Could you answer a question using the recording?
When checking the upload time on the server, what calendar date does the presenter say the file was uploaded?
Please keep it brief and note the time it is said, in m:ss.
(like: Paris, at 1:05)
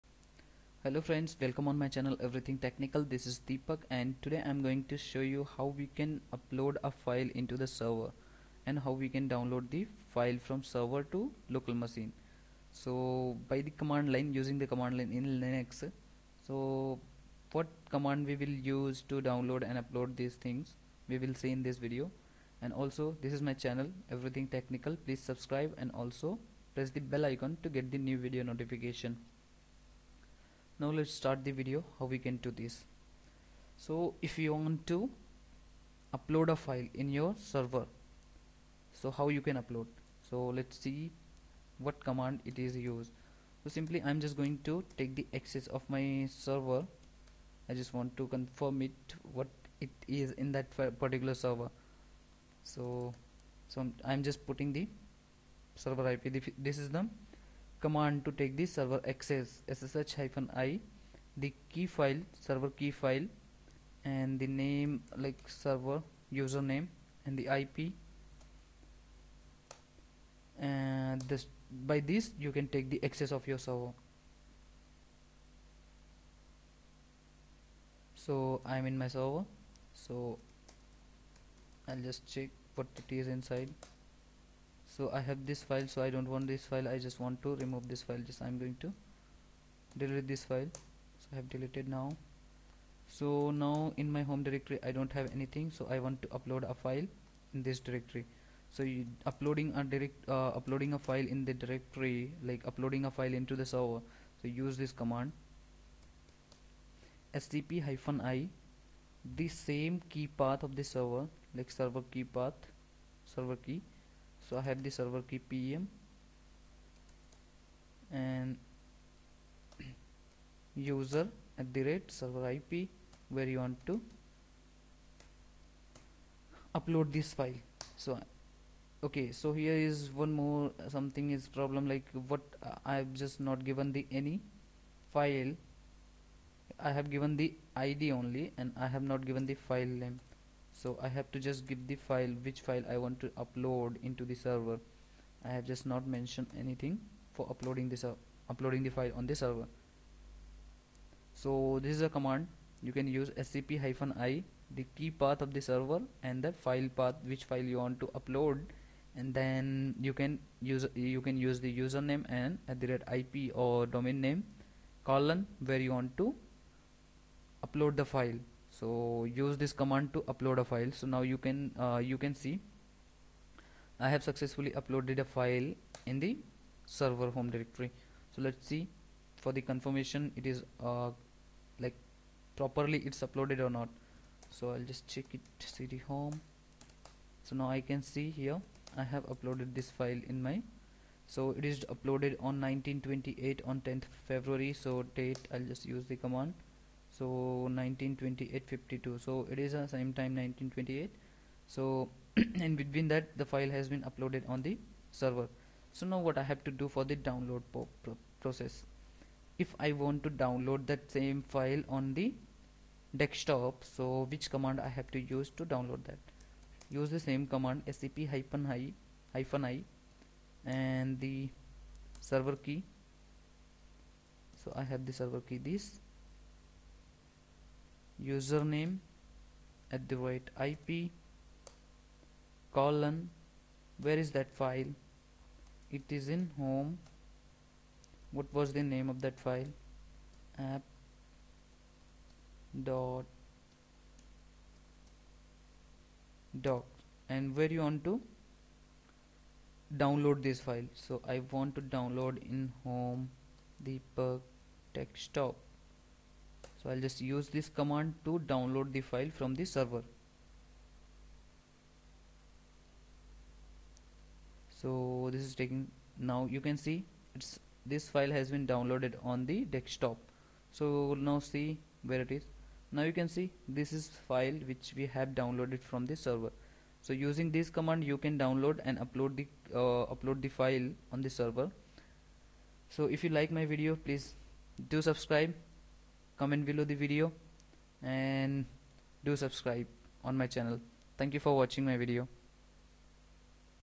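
10th February, at 3:13.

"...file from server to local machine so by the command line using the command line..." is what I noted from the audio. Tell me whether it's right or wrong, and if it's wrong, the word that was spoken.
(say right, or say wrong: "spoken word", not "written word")
right.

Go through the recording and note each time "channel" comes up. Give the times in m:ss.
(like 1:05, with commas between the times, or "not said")
0:01, 0:23, 4:50.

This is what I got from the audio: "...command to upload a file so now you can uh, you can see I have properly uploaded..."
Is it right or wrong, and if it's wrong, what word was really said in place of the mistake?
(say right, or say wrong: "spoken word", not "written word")
wrong: "successfully", not "properly".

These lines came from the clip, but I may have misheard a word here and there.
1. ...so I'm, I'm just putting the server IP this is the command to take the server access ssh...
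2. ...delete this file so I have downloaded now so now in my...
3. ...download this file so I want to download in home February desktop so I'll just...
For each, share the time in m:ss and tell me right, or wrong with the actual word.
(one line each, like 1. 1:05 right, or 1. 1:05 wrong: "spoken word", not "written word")
1. 0:53 right
2. 1:29 wrong: "deleted", not "downloaded"
3. 4:10 wrong: "Deepak", not "February".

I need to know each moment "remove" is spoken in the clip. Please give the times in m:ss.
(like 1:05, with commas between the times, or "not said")
1:27.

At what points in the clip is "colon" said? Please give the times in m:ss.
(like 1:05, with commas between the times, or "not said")
2:45, 3:52.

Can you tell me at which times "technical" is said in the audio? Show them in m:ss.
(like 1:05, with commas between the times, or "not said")
0:02, 0:24.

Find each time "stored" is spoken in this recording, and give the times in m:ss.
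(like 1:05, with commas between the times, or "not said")
not said.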